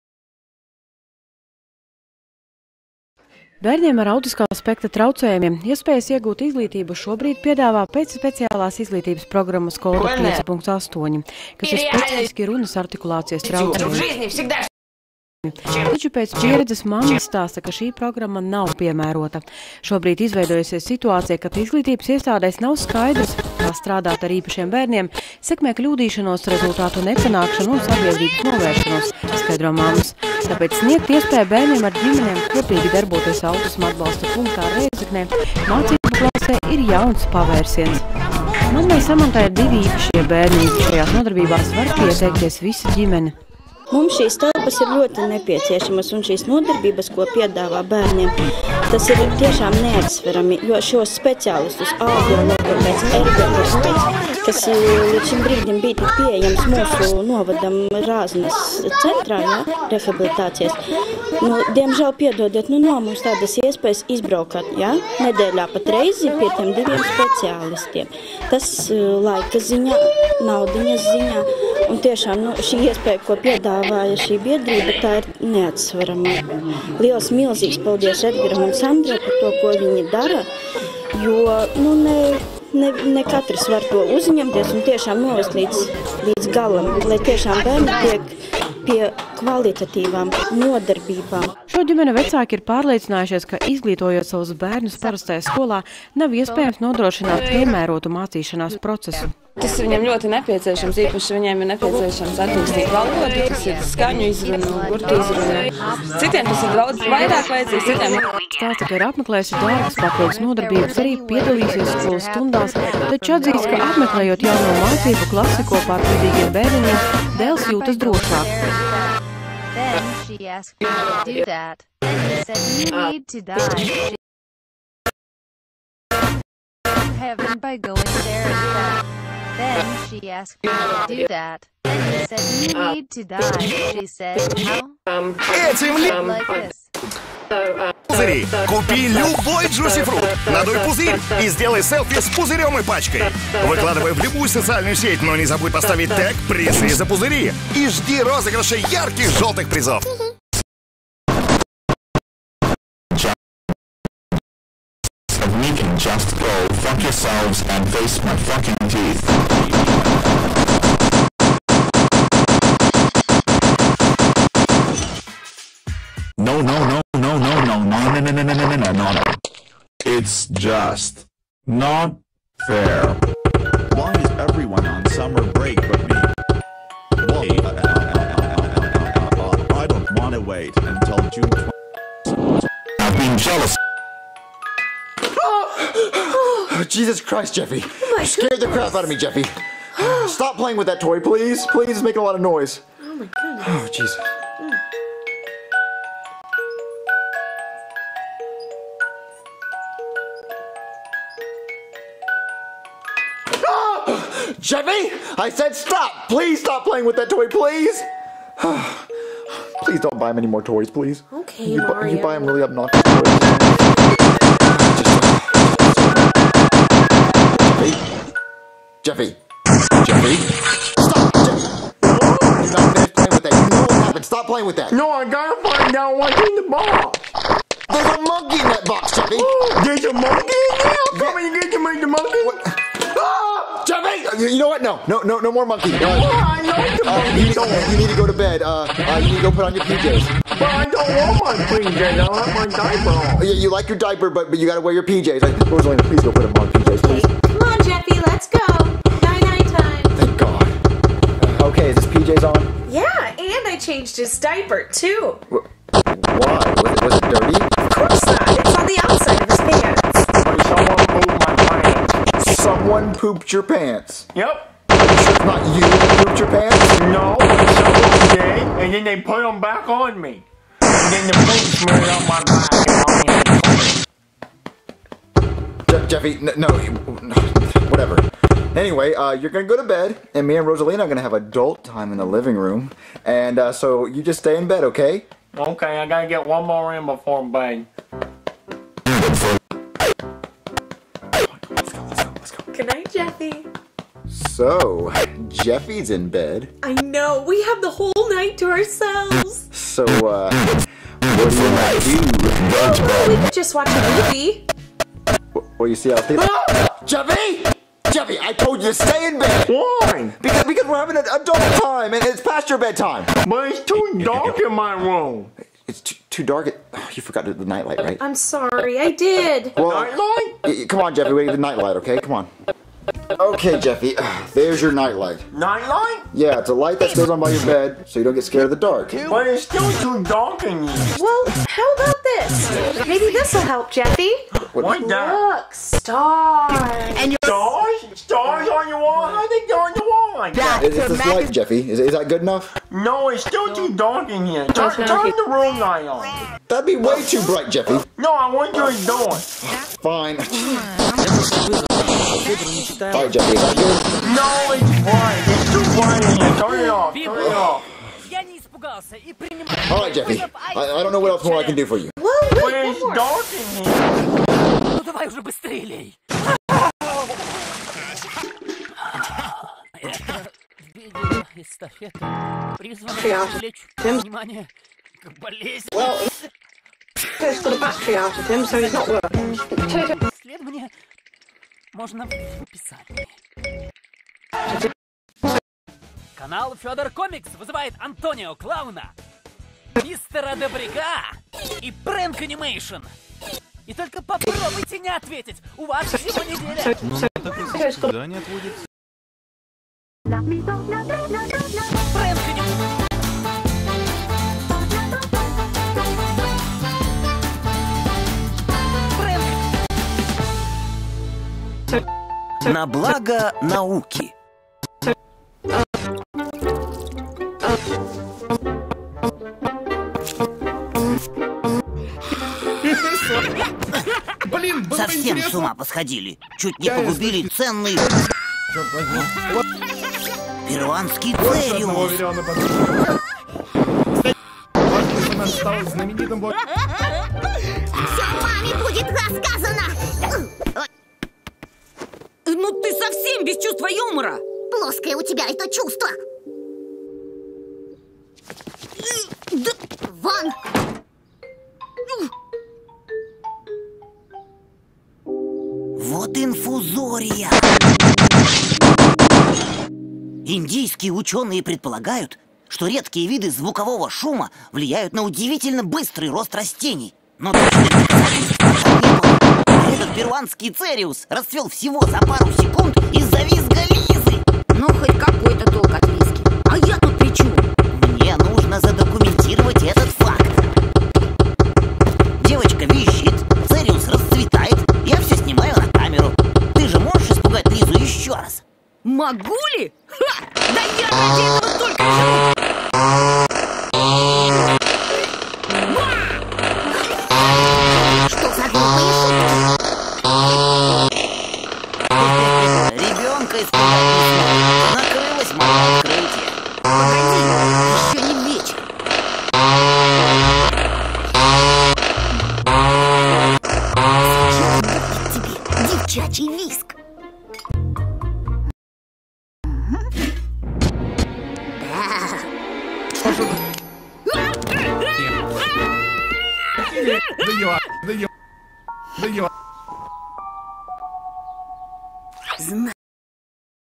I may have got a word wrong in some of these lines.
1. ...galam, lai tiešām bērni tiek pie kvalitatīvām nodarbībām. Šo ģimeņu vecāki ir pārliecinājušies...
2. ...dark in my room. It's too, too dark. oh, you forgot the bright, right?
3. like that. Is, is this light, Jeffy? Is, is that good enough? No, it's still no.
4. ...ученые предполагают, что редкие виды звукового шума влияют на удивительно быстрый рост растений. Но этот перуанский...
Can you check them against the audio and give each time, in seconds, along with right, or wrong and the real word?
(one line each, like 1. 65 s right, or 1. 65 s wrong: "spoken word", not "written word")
1. 86 s right
2. 314 s wrong: "nightlight", not "bright"
3. 340 s right
4. 461 s right.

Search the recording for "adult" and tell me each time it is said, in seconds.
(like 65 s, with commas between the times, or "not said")
281 s, 311 s.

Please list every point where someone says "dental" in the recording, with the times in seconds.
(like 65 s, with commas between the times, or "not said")
not said.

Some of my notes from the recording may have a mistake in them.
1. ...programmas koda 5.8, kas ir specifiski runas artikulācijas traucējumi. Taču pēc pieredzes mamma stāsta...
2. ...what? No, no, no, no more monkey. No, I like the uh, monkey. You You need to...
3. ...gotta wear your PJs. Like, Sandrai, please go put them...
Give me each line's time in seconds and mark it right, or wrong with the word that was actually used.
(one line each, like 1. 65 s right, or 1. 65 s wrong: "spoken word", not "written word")
1. 9 s right
2. 234 s right
3. 244 s wrong: "Rosalina", not "Sandrai".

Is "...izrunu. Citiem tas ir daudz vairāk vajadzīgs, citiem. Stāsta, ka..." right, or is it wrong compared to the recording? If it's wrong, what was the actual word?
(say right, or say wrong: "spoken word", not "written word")
right.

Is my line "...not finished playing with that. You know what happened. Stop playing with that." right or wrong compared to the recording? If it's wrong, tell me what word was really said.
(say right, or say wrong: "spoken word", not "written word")
right.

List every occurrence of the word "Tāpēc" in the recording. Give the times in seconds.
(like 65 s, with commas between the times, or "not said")
30 s.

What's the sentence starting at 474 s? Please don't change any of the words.
Ну, хоть какой-то толк от визги.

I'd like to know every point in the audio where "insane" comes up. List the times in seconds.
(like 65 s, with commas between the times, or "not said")
not said.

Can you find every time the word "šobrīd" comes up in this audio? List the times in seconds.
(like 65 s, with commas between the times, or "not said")
6 s, 19 s.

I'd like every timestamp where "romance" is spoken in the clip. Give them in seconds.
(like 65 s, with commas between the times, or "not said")
not said.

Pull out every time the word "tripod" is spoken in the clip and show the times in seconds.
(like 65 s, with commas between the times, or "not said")
not said.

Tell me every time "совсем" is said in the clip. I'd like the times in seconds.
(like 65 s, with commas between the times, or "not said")
424 s, 442 s.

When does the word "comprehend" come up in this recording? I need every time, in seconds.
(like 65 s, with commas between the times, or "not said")
not said.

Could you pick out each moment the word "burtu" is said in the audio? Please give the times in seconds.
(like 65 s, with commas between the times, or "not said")
104 s.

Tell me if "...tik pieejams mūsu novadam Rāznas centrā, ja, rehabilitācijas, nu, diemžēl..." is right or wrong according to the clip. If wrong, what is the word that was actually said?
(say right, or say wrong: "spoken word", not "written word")
right.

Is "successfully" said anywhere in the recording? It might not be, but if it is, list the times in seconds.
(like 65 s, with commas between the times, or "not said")
not said.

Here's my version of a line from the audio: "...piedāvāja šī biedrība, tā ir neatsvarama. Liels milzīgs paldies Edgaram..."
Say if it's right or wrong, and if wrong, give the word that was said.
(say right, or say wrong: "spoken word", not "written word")
right.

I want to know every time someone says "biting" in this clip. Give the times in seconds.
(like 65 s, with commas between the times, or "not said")
not said.